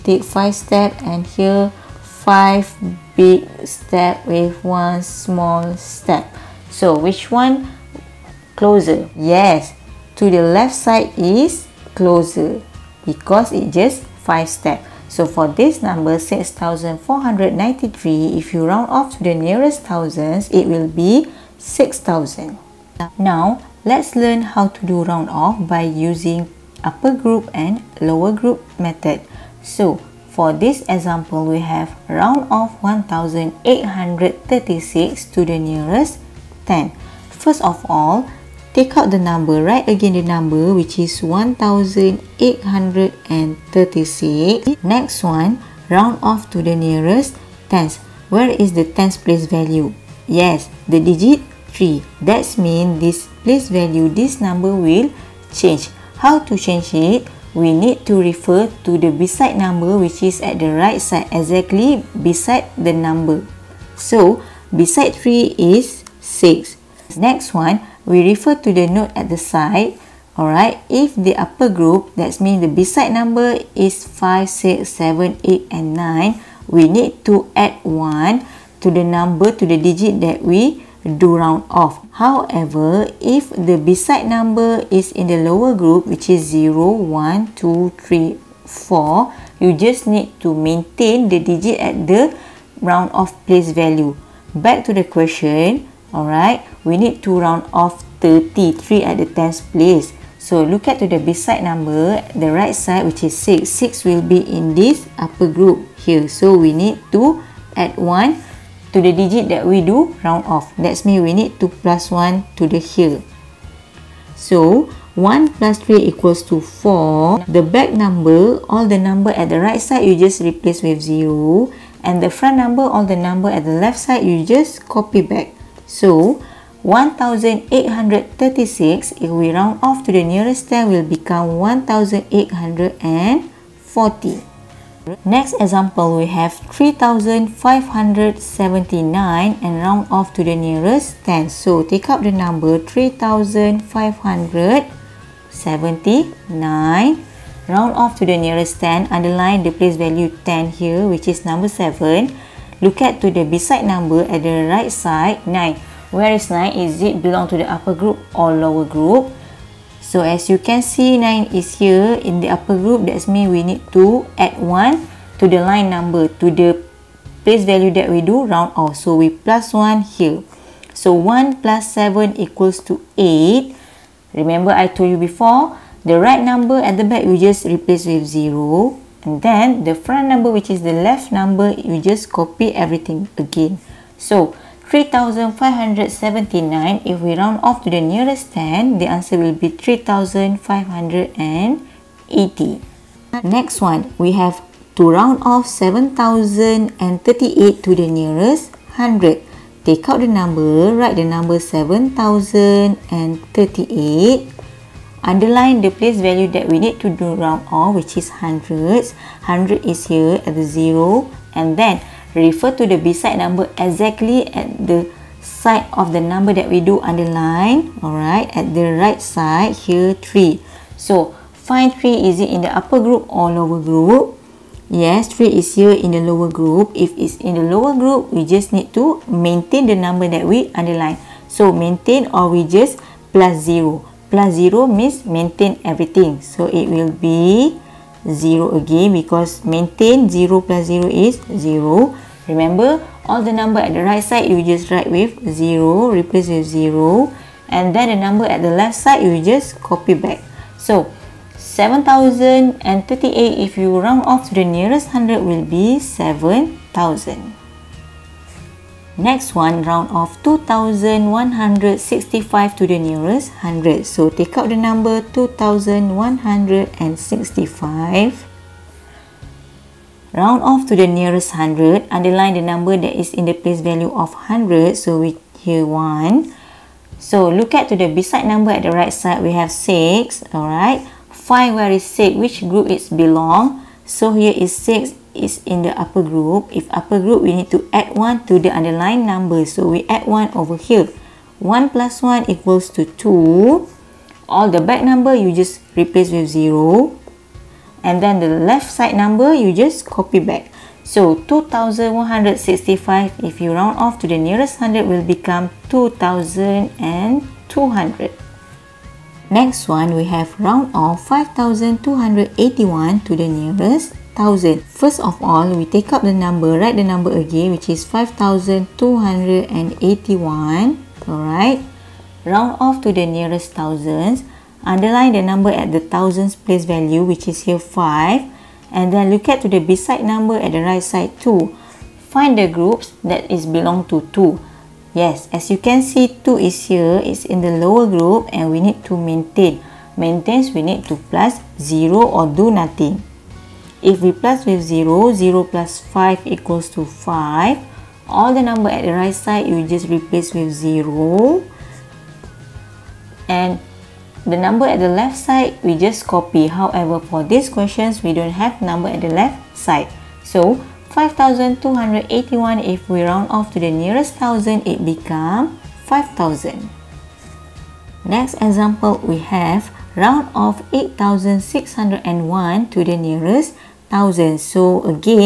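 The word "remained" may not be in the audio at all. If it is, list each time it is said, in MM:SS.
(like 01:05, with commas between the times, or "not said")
not said.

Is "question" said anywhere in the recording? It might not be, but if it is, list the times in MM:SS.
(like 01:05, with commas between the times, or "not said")
01:35, 05:57.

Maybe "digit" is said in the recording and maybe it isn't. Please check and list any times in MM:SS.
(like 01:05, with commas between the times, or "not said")
00:51, 01:19, 01:31, 01:49.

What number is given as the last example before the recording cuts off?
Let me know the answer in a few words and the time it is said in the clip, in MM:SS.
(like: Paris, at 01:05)
8601, at 06:10.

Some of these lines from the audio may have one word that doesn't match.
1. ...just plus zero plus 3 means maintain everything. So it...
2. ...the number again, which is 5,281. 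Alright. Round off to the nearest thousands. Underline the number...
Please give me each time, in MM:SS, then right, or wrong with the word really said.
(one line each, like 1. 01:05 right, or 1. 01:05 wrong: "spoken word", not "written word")
1. 03:52 wrong: "0", not "3"
2. 05:16 right.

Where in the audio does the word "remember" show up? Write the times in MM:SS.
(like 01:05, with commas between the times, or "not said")
02:54, 04:02.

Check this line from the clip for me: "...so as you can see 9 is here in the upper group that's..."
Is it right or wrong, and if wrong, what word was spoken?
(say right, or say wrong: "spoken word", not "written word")
right.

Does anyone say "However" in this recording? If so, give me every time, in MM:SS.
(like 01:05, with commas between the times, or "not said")
01:22, 05:56.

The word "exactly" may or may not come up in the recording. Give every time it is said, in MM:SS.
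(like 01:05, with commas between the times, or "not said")
01:01, 03:33.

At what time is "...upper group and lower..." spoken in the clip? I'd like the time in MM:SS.
00:26.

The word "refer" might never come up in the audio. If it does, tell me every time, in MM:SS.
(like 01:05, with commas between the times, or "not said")
00:58, 01:08, 03:32.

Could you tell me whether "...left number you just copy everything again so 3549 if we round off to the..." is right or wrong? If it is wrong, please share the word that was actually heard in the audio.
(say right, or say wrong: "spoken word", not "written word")
wrong: "3579", not "3549".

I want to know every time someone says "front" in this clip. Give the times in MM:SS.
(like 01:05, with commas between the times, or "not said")
02:02, 02:59.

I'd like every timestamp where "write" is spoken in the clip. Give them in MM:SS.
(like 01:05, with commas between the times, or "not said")
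00:39, 03:20, 04:04, 05:16.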